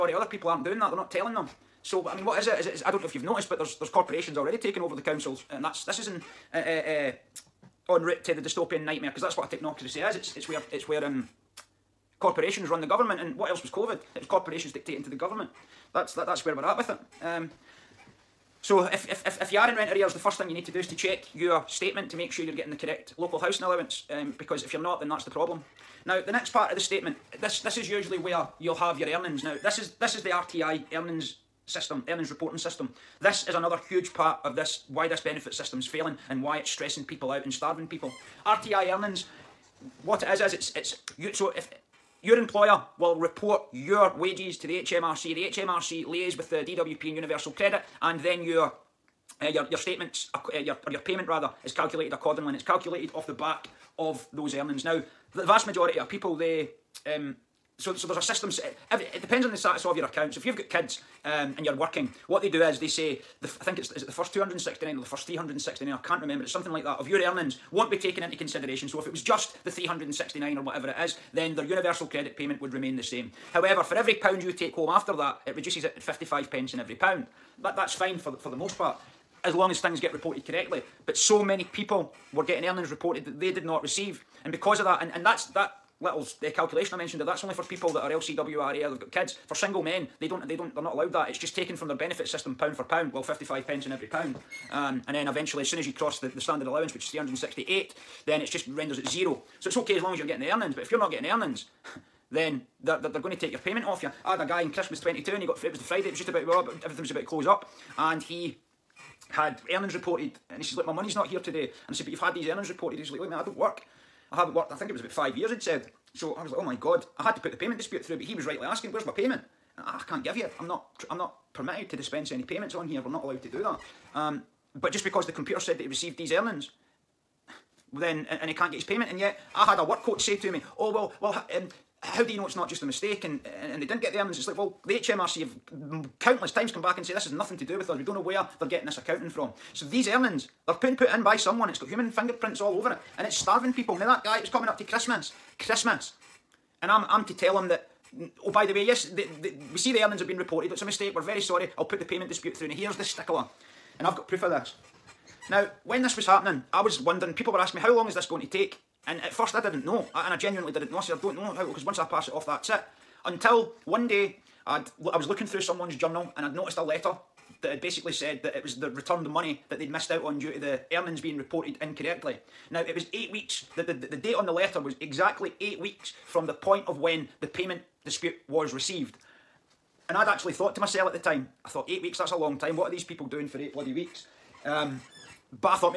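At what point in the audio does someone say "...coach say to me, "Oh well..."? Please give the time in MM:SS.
02:10.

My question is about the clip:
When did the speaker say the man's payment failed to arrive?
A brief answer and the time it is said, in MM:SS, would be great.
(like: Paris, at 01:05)
Christmas 2022, at 01:44.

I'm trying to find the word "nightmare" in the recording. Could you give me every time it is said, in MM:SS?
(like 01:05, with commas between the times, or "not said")
00:08.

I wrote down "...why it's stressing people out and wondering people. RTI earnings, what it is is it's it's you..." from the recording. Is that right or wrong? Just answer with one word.
wrong.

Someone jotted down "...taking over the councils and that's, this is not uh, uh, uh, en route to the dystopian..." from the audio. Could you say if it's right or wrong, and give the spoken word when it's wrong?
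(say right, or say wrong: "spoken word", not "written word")
right.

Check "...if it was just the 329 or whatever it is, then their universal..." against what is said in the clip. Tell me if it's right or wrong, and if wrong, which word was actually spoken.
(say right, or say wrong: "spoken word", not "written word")
wrong: "369", not "329".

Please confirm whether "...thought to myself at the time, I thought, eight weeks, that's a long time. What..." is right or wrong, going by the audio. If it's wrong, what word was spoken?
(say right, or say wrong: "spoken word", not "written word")
right.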